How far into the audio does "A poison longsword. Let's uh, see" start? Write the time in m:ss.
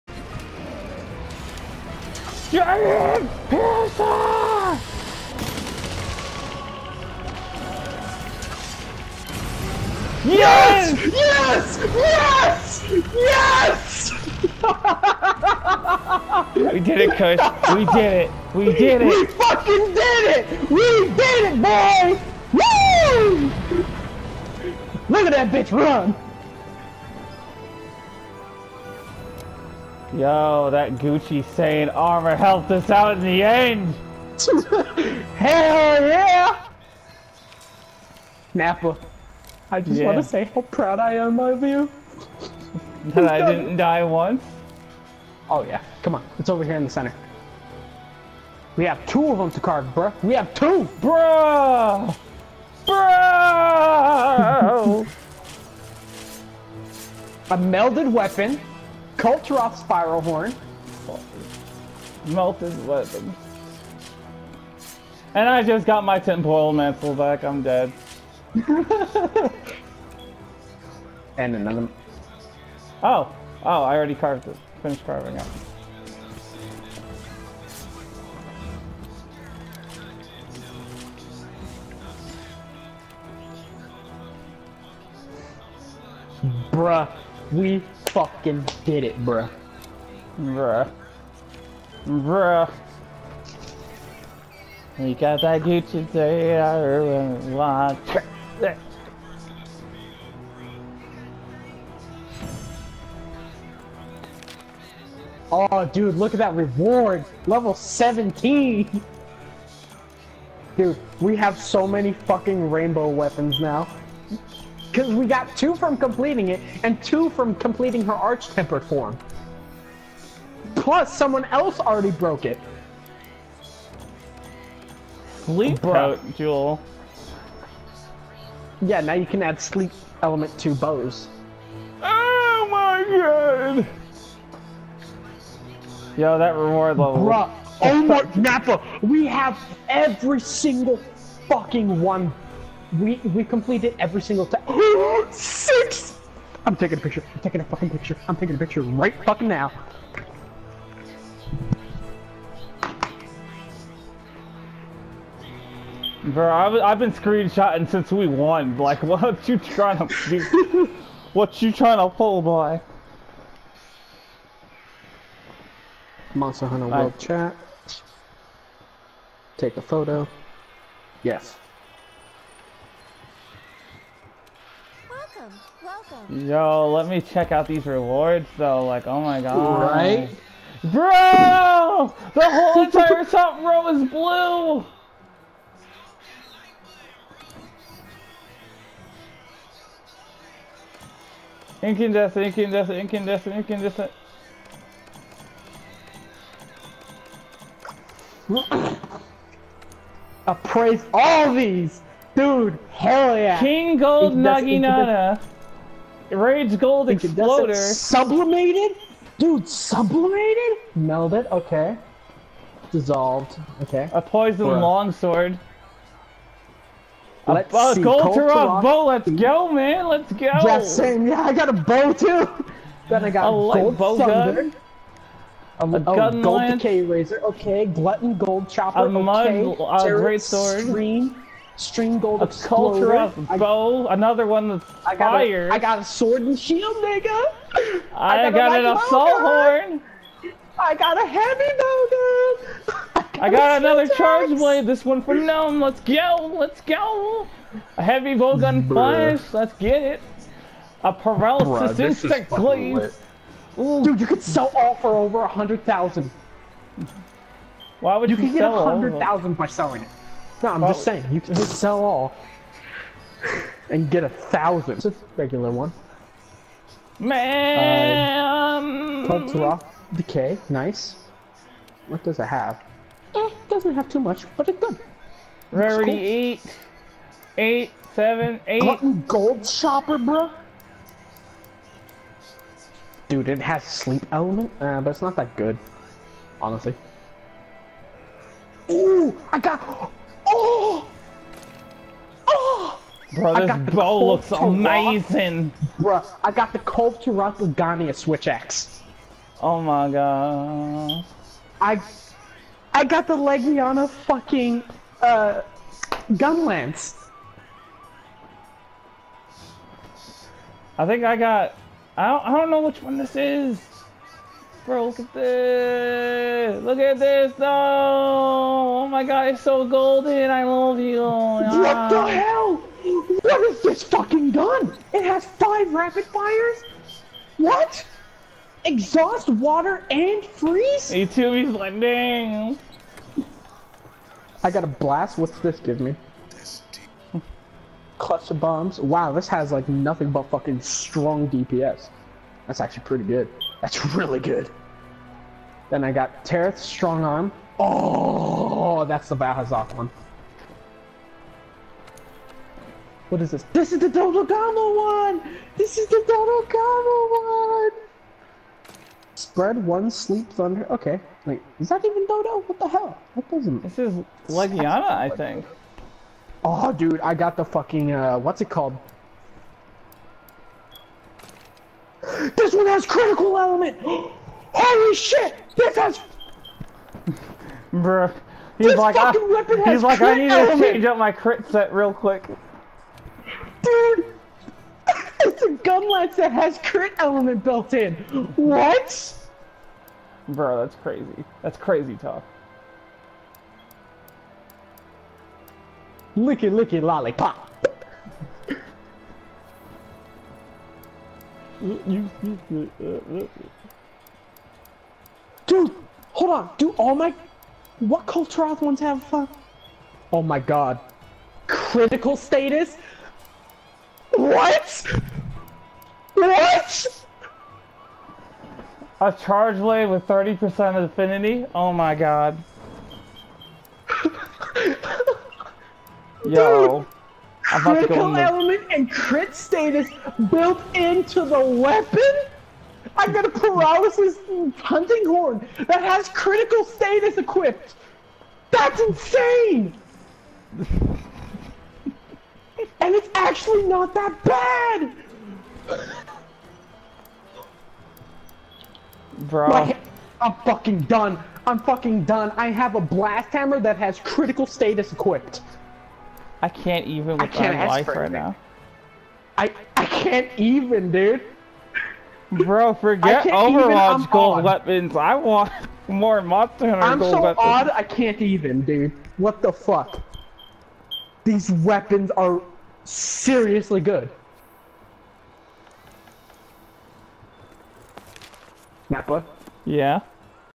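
3:34.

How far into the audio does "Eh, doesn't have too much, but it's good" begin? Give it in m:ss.
4:33.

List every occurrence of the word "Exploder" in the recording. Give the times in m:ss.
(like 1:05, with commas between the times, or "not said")
3:27.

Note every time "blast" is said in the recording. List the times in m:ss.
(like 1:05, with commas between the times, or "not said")
5:34, 7:33.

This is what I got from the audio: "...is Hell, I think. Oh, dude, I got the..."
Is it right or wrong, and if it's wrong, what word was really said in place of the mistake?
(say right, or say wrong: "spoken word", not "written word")
wrong: "Legiana", not "Hell".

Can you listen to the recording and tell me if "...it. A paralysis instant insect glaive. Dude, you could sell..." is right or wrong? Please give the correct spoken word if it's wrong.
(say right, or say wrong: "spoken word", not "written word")
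right.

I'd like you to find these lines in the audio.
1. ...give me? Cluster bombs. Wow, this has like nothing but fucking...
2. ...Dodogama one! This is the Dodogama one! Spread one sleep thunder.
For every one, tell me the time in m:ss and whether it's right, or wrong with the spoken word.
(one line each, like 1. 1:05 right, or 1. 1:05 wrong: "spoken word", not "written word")
1. 5:35 right
2. 5:54 right.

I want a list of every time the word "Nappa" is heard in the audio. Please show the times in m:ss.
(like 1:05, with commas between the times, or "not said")
0:38, 2:18, 7:59.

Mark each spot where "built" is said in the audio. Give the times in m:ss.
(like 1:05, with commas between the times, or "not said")
6:27, 7:10.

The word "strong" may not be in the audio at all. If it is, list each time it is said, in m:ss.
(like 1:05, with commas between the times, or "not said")
5:40, 5:46.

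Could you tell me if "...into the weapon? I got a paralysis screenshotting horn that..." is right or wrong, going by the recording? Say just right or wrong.
wrong.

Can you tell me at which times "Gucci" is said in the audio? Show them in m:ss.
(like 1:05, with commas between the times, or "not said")
0:30, 1:35.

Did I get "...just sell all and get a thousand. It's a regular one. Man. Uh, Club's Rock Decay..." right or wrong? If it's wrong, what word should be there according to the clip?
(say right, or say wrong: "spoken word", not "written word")
right.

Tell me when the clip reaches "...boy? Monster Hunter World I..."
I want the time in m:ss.
2:42.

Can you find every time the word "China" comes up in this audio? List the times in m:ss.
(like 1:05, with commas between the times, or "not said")
not said.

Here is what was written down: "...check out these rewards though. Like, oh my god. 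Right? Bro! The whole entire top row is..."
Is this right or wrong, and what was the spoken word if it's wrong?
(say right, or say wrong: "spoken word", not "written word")
right.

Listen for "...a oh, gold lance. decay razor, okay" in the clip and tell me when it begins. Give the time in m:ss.
3:45.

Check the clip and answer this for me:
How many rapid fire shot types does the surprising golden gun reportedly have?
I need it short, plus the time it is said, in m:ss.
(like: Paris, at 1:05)
5, at 5:25.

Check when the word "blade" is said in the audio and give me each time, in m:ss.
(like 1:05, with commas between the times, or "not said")
4:04, 6:59.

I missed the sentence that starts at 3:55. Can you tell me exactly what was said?
A, I got a sword and shield, nigga.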